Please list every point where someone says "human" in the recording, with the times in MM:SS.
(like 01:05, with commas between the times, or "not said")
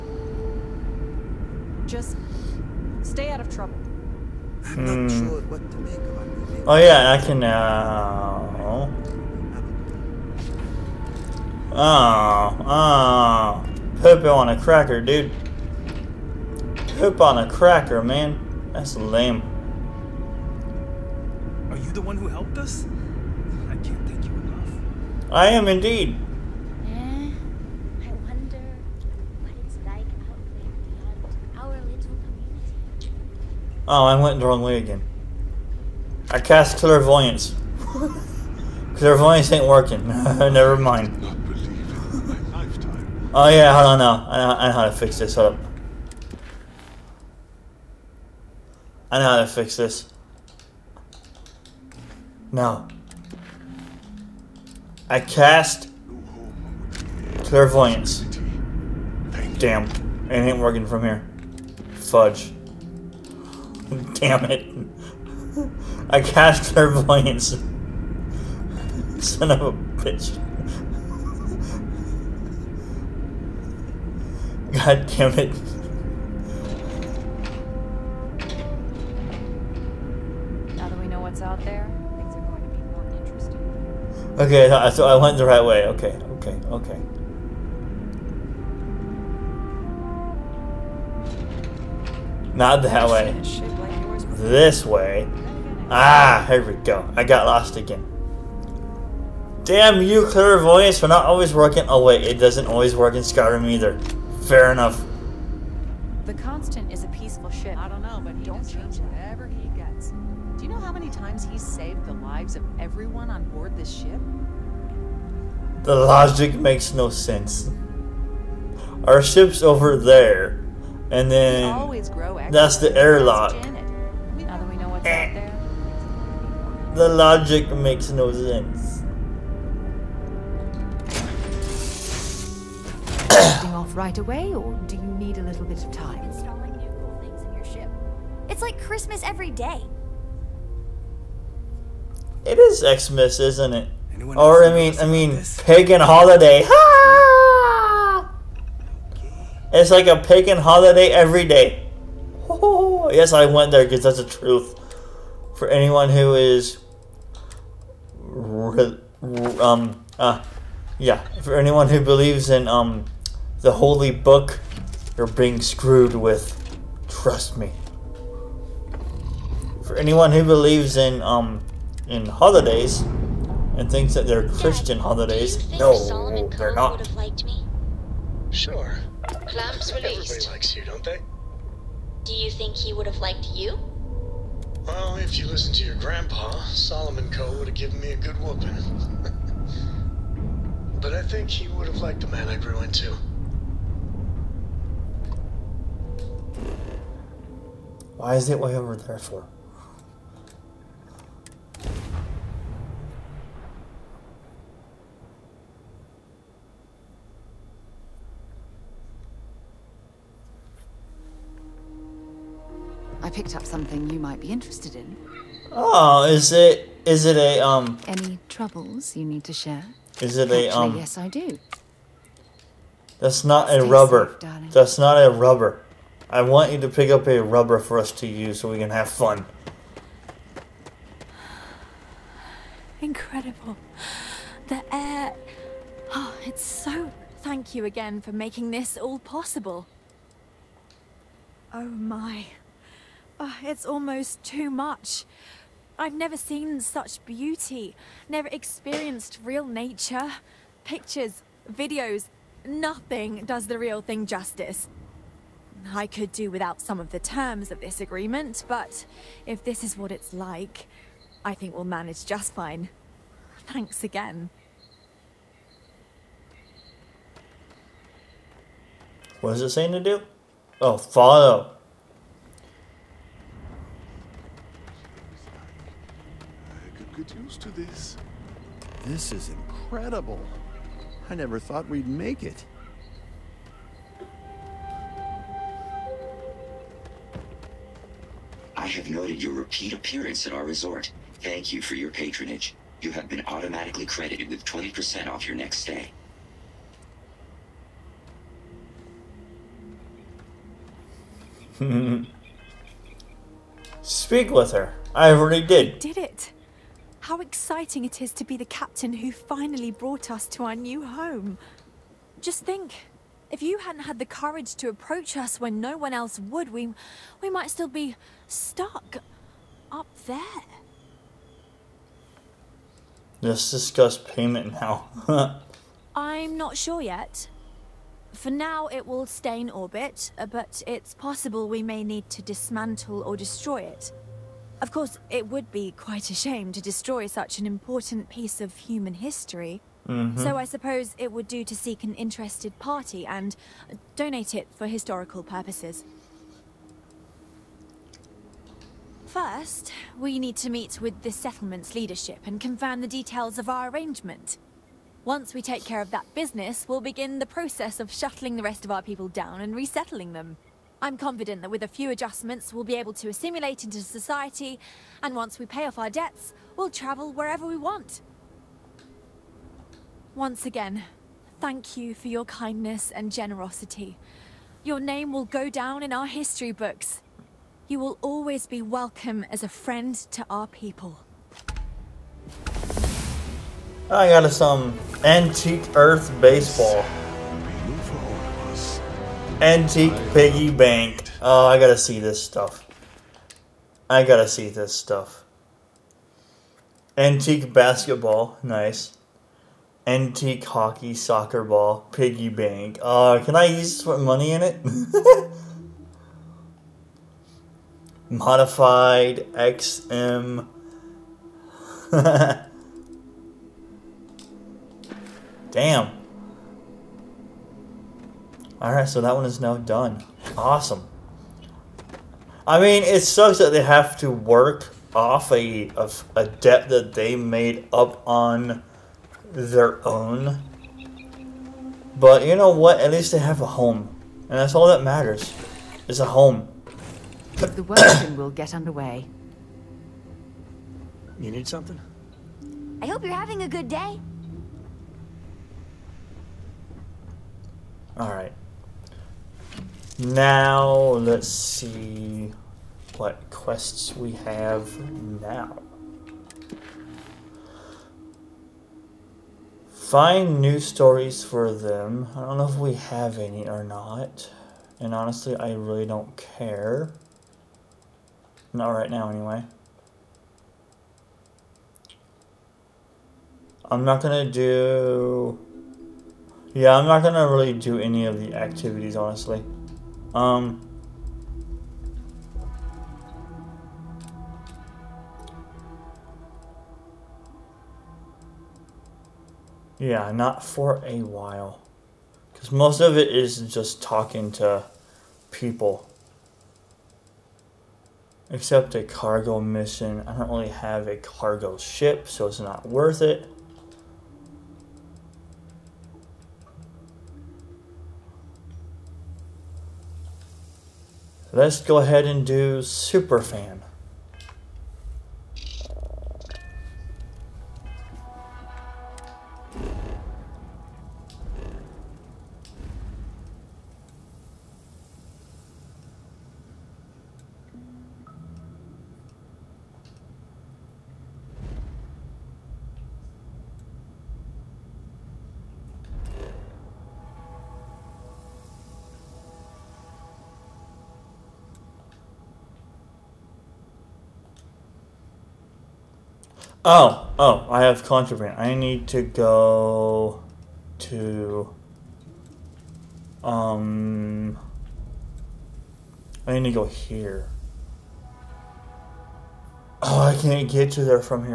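05:38.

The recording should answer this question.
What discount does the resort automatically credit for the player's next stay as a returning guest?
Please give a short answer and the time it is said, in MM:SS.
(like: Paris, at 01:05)
20%, at 04:54.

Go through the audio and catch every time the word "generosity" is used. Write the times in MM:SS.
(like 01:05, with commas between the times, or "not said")
06:13.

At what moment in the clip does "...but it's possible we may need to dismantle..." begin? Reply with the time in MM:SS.
05:30.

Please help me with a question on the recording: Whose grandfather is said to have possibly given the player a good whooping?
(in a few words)
Solomon Coe.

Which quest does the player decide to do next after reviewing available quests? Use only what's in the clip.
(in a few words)
Superfan.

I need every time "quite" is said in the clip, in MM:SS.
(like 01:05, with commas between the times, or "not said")
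05:35.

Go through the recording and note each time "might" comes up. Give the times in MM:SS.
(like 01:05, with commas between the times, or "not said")
03:34, 05:17.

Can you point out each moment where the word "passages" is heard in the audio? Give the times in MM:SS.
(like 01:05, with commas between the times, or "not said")
not said.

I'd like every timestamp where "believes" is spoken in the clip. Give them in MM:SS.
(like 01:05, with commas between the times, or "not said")
02:42, 02:50.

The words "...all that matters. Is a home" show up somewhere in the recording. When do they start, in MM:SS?
07:14.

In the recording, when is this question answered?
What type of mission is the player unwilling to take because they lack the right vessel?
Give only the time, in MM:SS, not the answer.
08:19.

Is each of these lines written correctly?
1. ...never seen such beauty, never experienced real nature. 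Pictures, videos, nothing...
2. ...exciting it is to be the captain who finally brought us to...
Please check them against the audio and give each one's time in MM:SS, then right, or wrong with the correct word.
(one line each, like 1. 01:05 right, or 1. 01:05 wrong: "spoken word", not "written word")
1. 04:06 right
2. 05:07 right.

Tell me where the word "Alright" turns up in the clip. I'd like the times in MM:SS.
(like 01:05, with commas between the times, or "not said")
06:58, 07:28.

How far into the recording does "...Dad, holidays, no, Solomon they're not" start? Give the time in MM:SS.
02:54.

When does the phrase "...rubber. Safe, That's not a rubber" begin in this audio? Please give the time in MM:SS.
03:43.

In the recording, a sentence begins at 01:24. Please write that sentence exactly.
Okay, so I went the right way.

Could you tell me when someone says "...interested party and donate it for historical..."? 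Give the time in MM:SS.
05:42.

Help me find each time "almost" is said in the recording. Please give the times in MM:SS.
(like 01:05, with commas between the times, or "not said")
04:03.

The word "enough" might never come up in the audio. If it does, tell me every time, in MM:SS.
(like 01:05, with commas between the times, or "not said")
00:24, 01:44.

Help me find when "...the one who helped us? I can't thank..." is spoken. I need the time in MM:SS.
00:21.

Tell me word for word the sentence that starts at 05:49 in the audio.
First, we need to meet with the settlement's leadership and confirm the details of our arrangement.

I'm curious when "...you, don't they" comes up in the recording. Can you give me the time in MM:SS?
03:00.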